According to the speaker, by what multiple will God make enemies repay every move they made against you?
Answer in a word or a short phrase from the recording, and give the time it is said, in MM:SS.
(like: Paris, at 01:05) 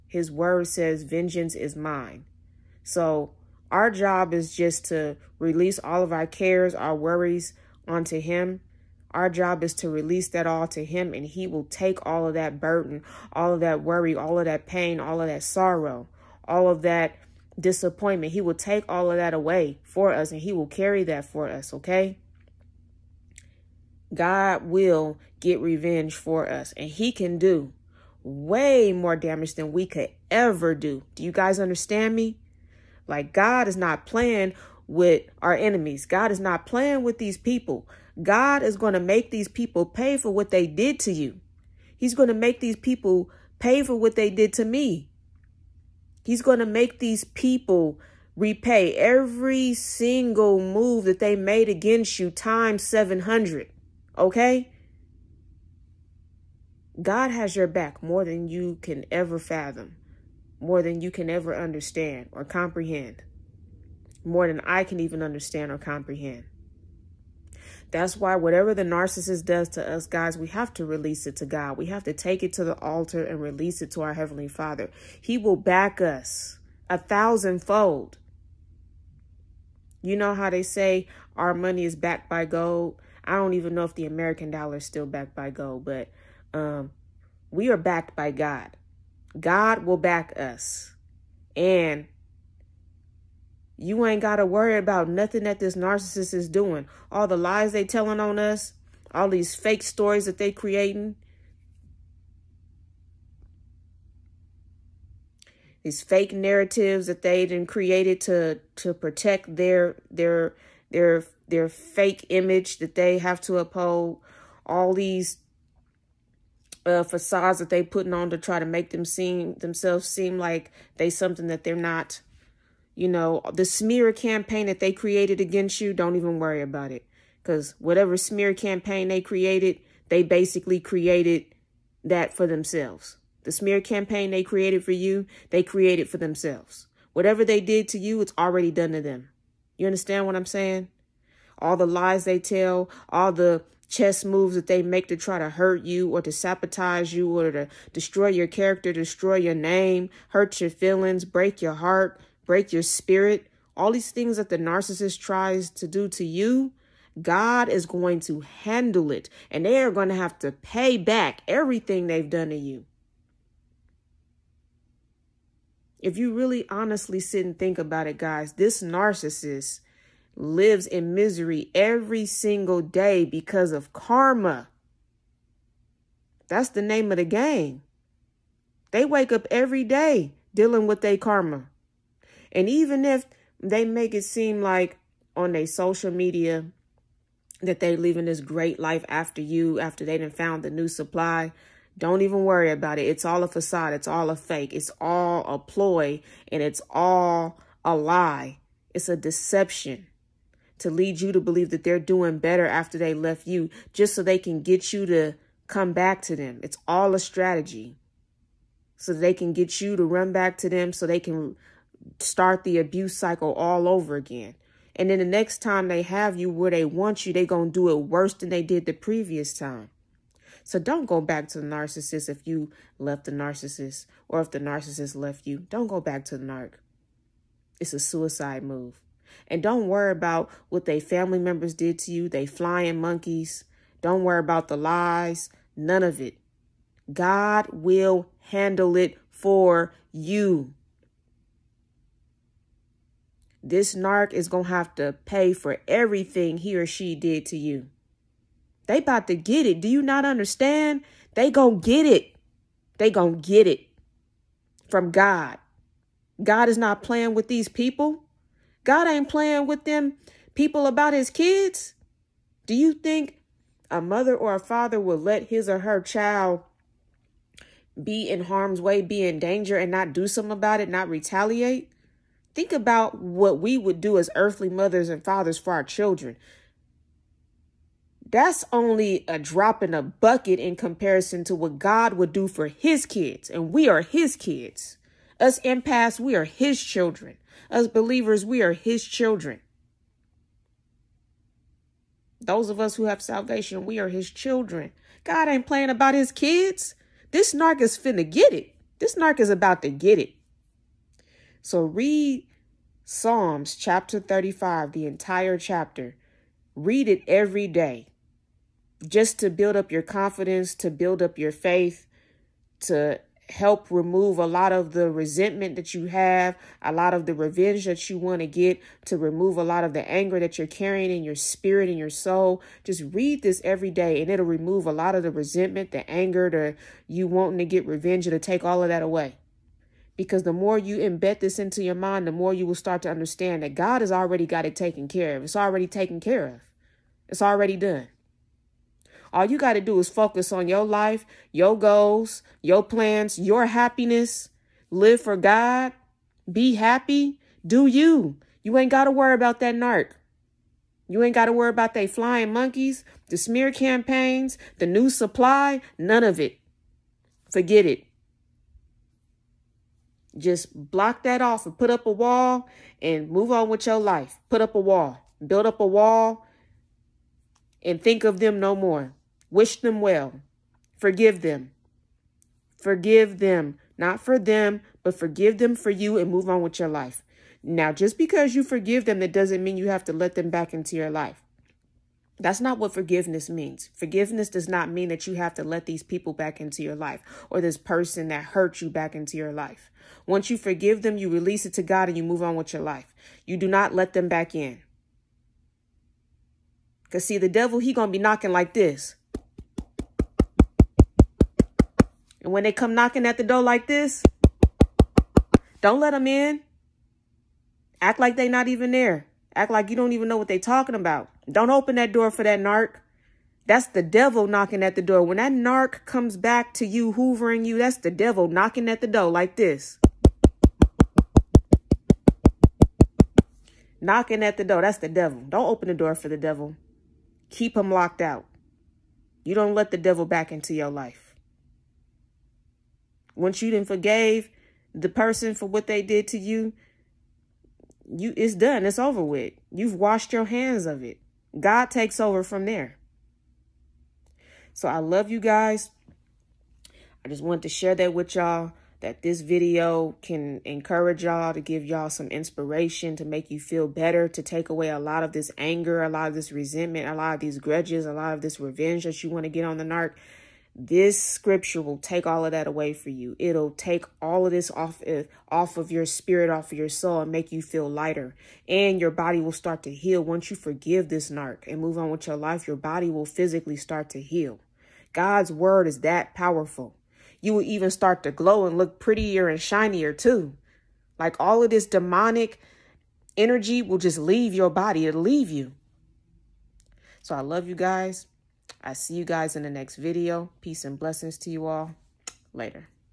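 times 700, at 00:52.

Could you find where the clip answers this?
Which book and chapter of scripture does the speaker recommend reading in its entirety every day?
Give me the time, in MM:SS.
05:03.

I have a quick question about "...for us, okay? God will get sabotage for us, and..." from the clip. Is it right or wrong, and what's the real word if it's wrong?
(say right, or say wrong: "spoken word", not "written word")
wrong: "revenge", not "sabotage".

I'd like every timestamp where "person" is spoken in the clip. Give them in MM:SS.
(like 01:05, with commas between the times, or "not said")
06:27, 07:15.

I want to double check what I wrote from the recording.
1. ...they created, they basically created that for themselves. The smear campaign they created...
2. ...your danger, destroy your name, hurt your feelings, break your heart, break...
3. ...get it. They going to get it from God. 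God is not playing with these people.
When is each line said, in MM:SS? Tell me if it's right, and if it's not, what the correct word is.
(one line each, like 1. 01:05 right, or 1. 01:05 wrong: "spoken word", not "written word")
1. 02:09 right
2. 02:28 wrong: "character", not "danger"
3. 04:11 right.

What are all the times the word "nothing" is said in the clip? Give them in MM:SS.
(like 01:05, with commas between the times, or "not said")
01:35.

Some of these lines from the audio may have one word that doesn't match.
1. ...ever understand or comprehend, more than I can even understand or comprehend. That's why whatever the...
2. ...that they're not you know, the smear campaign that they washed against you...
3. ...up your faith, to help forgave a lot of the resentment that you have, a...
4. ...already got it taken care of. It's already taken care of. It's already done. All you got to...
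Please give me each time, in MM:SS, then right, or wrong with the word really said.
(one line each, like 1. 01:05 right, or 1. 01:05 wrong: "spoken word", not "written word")
1. 01:01 right
2. 02:01 wrong: "created", not "washed"
3. 05:11 wrong: "remove", not "forgave"
4. 05:34 right.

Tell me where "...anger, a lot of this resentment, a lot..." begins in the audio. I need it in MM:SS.
07:35.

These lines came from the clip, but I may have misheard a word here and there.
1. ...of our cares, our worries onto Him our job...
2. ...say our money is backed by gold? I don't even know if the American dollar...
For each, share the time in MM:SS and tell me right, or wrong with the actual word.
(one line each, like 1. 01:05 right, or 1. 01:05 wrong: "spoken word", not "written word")
1. 00:06 right
2. 01:20 right.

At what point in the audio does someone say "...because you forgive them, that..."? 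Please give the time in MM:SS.
06:18.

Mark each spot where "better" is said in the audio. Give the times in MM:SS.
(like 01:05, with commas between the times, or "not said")
03:22, 07:33.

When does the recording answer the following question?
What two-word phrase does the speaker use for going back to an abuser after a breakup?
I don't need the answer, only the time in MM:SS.
03:47.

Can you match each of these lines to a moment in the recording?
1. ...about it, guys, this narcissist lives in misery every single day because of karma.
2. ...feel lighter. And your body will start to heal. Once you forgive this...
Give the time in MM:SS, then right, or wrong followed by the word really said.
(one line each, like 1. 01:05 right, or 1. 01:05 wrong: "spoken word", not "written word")
1. 02:47 right
2. 07:47 right.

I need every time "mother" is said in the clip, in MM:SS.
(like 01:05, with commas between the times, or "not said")
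04:24, 04:34.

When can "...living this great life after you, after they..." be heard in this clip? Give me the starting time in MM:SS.
03:07.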